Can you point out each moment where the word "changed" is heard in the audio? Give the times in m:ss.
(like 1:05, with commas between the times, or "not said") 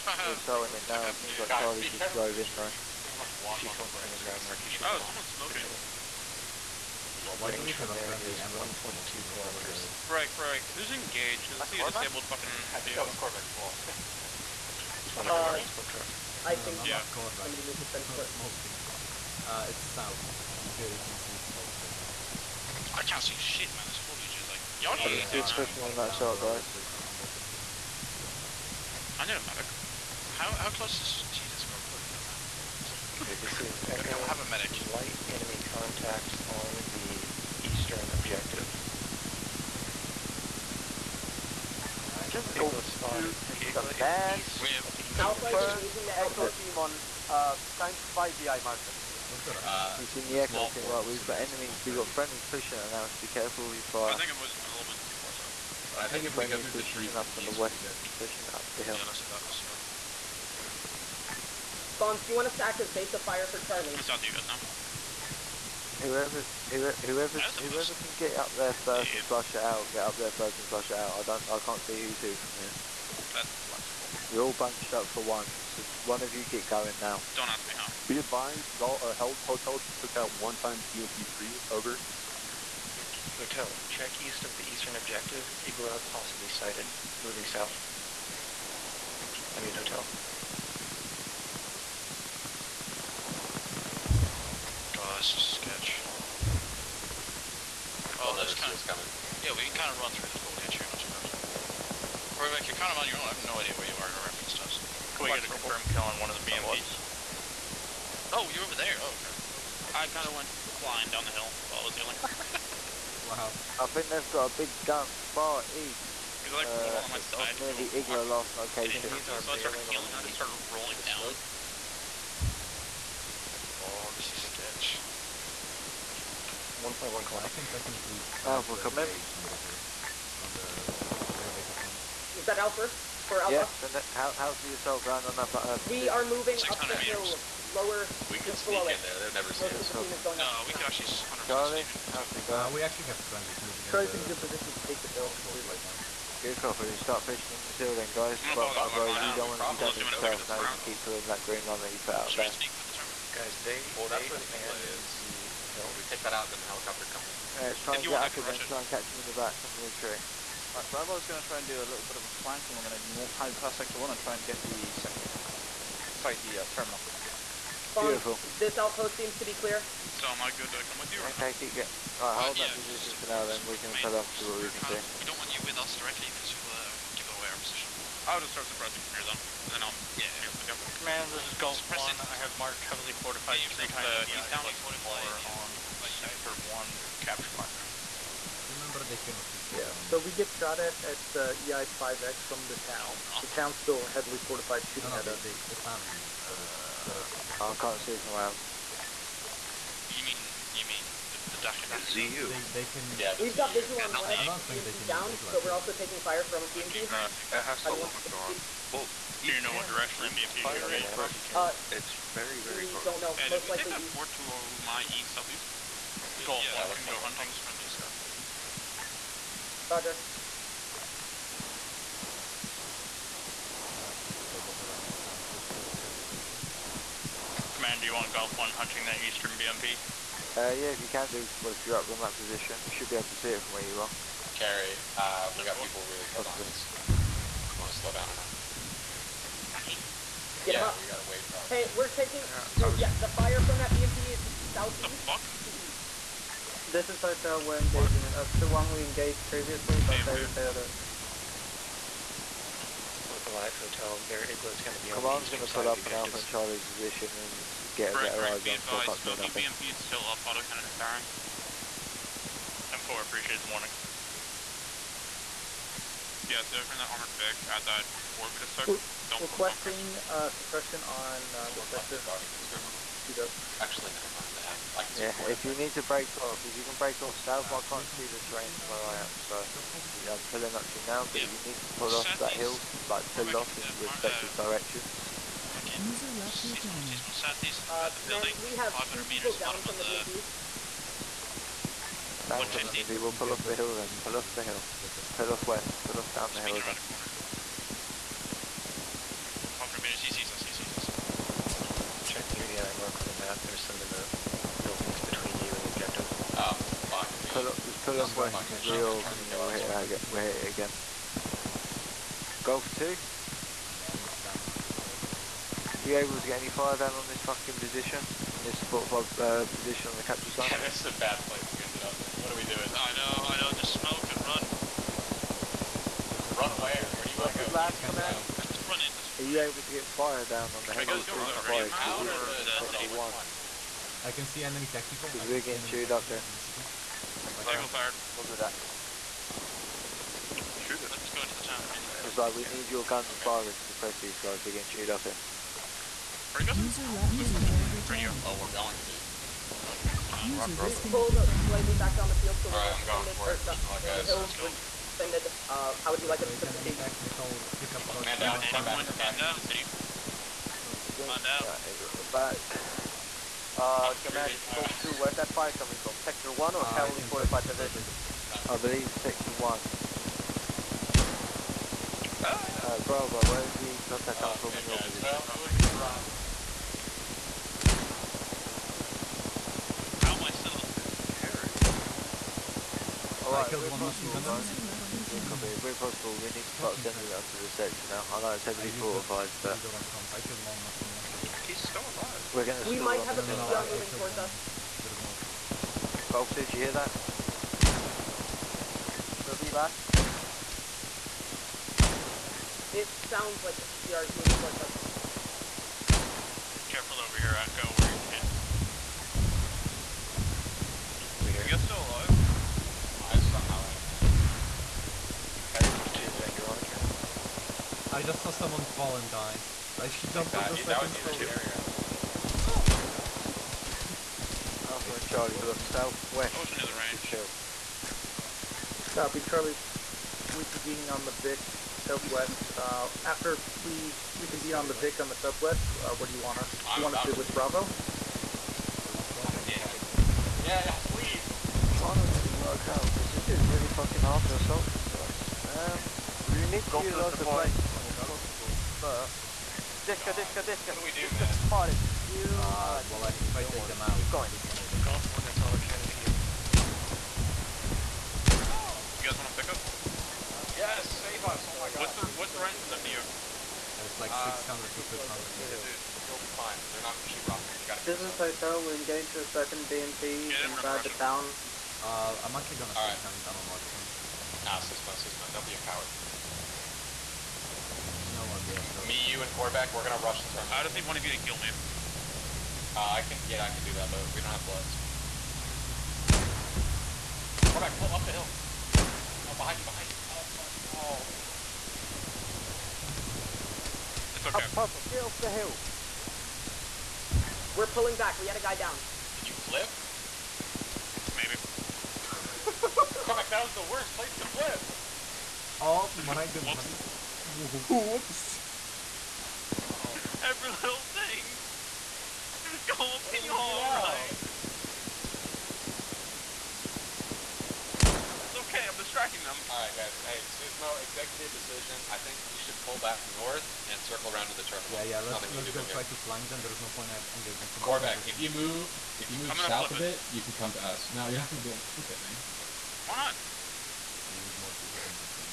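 not said.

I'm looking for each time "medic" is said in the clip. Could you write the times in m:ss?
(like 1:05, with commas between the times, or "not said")
0:29, 0:34.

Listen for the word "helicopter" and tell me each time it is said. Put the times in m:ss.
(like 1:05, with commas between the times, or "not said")
2:36, 5:30.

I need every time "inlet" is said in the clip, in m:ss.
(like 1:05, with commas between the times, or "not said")
2:34.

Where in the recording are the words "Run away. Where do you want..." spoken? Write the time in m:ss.
5:26.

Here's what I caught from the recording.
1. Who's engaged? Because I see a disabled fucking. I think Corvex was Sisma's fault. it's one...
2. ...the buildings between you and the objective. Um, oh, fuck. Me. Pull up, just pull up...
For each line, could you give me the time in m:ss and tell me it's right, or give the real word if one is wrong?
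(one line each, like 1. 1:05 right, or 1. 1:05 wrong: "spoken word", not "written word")
1. 0:10 wrong: "Corvac", not "Sisma"
2. 5:04 right.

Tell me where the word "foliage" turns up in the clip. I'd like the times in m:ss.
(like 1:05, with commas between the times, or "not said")
0:23, 1:40.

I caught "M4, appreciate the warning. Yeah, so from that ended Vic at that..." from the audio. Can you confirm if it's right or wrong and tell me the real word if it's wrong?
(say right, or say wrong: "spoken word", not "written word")
wrong: "armored", not "ended".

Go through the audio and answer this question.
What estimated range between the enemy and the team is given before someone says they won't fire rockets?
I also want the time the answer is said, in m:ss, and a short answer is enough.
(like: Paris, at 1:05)
600 to 500 meters, at 7:44.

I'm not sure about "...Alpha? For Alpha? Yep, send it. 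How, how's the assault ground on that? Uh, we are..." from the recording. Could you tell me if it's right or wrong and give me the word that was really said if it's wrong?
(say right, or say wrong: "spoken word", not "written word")
right.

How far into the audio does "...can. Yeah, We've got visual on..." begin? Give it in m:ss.
3:22.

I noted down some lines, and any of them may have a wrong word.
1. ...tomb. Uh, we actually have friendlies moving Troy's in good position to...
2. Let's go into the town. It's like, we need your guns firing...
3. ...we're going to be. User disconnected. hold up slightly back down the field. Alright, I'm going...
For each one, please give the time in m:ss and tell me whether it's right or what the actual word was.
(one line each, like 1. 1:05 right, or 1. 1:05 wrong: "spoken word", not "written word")
1. 2:22 right
2. 5:41 right
3. 5:48 right.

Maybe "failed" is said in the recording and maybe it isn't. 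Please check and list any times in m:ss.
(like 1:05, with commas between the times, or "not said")
4:10.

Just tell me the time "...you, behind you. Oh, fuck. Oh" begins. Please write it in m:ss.
8:09.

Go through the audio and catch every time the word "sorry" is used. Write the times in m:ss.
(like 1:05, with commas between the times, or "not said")
0:00, 2:46, 7:58.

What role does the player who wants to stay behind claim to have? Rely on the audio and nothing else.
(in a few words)
Marksman.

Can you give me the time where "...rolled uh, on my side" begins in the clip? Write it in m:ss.
1:56.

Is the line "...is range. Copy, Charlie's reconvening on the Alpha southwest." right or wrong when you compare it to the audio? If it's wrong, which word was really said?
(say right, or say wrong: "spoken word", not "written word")
wrong: "Vic", not "Alpha".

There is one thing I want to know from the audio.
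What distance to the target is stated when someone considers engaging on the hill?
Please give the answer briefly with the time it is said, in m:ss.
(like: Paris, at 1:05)
1.1 kilometers, at 2:06.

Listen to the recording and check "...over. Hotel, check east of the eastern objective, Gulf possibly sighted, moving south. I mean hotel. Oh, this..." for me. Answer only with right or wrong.
wrong.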